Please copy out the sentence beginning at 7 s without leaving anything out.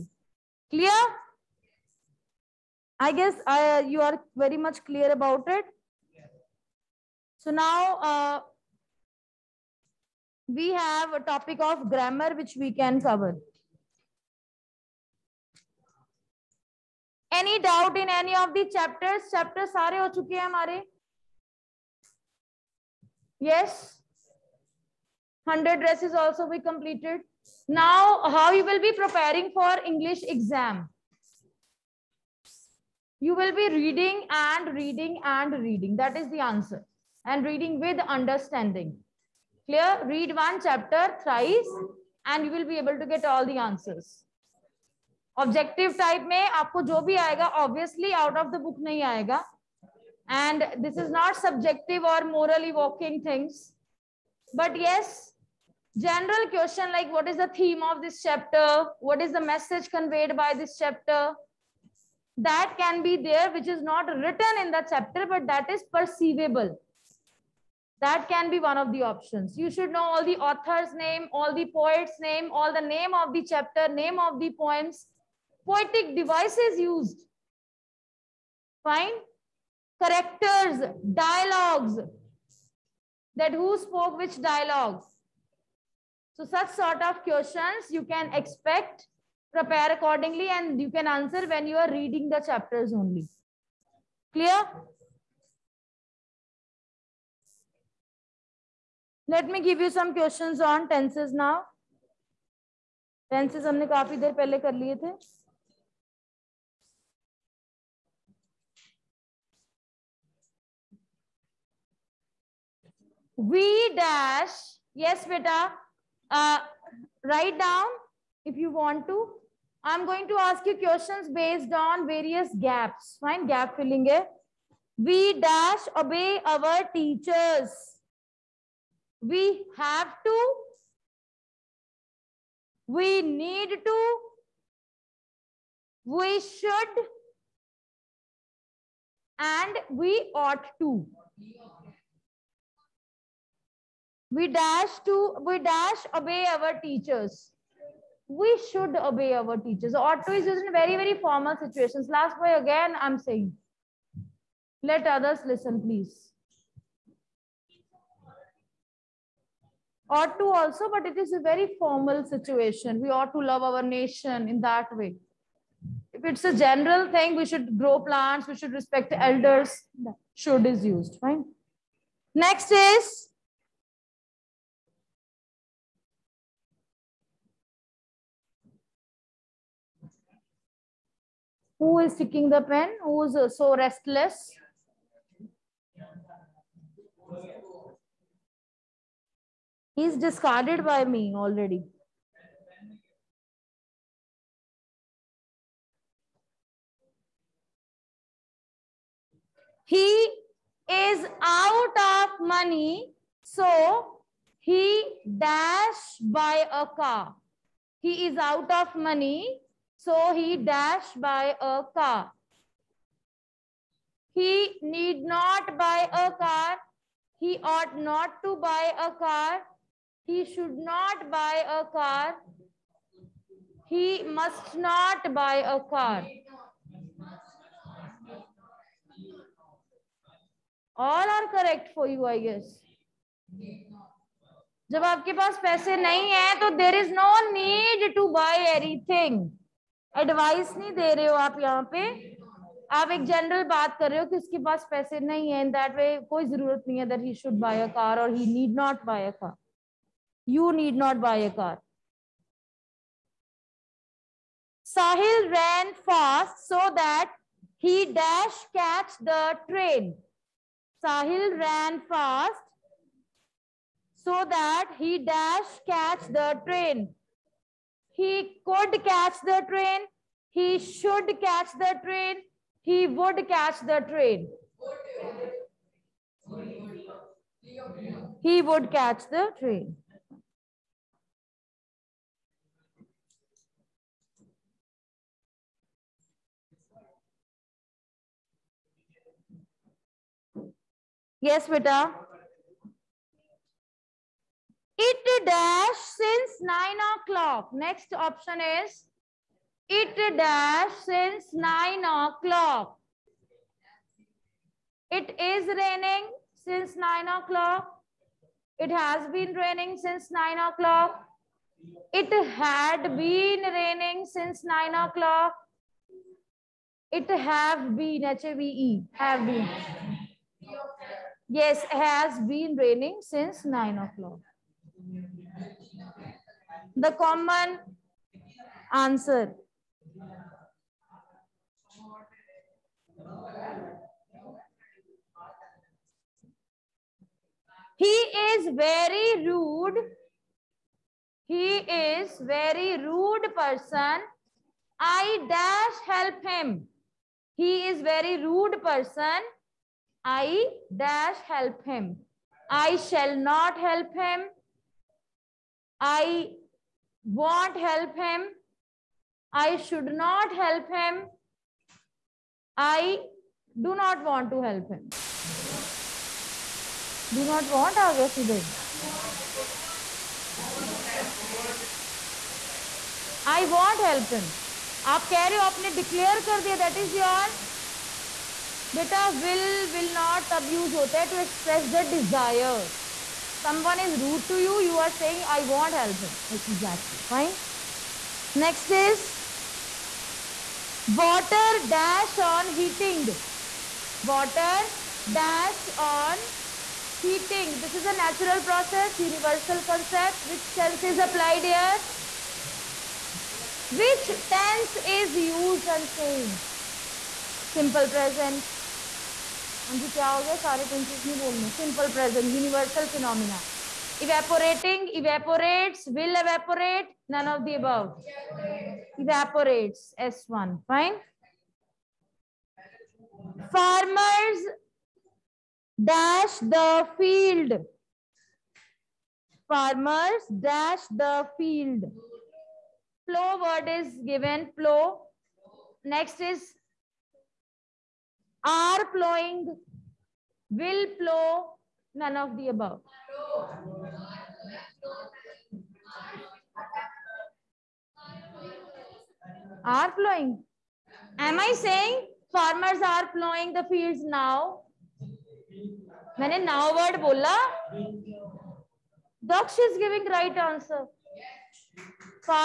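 So now, uh, we have a topic of grammar which we can cover.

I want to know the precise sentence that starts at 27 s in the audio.
Now, how you will be preparing for English exam?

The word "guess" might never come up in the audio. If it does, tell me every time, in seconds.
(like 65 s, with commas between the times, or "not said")
3 s, 232 s.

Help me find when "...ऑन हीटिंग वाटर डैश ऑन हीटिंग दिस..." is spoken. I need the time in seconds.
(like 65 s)
392 s.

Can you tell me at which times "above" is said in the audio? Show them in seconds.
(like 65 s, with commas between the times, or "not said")
442 s.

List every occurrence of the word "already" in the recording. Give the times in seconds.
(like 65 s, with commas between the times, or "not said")
191 s.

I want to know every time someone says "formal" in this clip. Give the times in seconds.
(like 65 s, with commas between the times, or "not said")
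151 s, 161 s.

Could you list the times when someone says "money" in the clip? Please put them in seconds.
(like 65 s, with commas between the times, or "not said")
202 s, 208 s.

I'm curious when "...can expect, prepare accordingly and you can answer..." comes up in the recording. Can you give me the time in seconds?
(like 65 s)
88 s.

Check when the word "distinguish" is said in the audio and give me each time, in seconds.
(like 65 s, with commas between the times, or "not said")
not said.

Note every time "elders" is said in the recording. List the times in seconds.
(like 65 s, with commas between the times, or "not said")
169 s.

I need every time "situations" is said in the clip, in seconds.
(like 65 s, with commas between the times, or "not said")
151 s, 162 s.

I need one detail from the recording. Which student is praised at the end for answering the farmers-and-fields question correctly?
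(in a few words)
Daksh.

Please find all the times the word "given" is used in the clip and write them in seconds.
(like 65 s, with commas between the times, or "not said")
434 s.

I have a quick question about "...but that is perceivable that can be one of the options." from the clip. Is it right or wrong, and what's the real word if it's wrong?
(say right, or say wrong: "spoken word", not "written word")
right.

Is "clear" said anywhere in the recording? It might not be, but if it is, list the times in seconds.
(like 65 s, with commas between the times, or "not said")
0 s, 4 s, 39 s, 94 s.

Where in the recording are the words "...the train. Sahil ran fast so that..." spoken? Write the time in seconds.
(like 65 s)
259 s.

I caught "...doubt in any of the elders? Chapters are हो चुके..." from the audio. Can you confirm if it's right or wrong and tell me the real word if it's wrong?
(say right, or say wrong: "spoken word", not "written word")
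wrong: "chapters", not "elders".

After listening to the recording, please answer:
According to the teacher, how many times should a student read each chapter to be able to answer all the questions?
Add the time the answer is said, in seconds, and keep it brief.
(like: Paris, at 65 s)
Thrice, at 41 s.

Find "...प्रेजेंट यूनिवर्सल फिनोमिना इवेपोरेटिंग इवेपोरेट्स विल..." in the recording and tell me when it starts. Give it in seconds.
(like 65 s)
412 s.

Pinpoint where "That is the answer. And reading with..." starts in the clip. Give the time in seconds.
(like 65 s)
35 s.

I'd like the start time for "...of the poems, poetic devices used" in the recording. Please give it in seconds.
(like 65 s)
74 s.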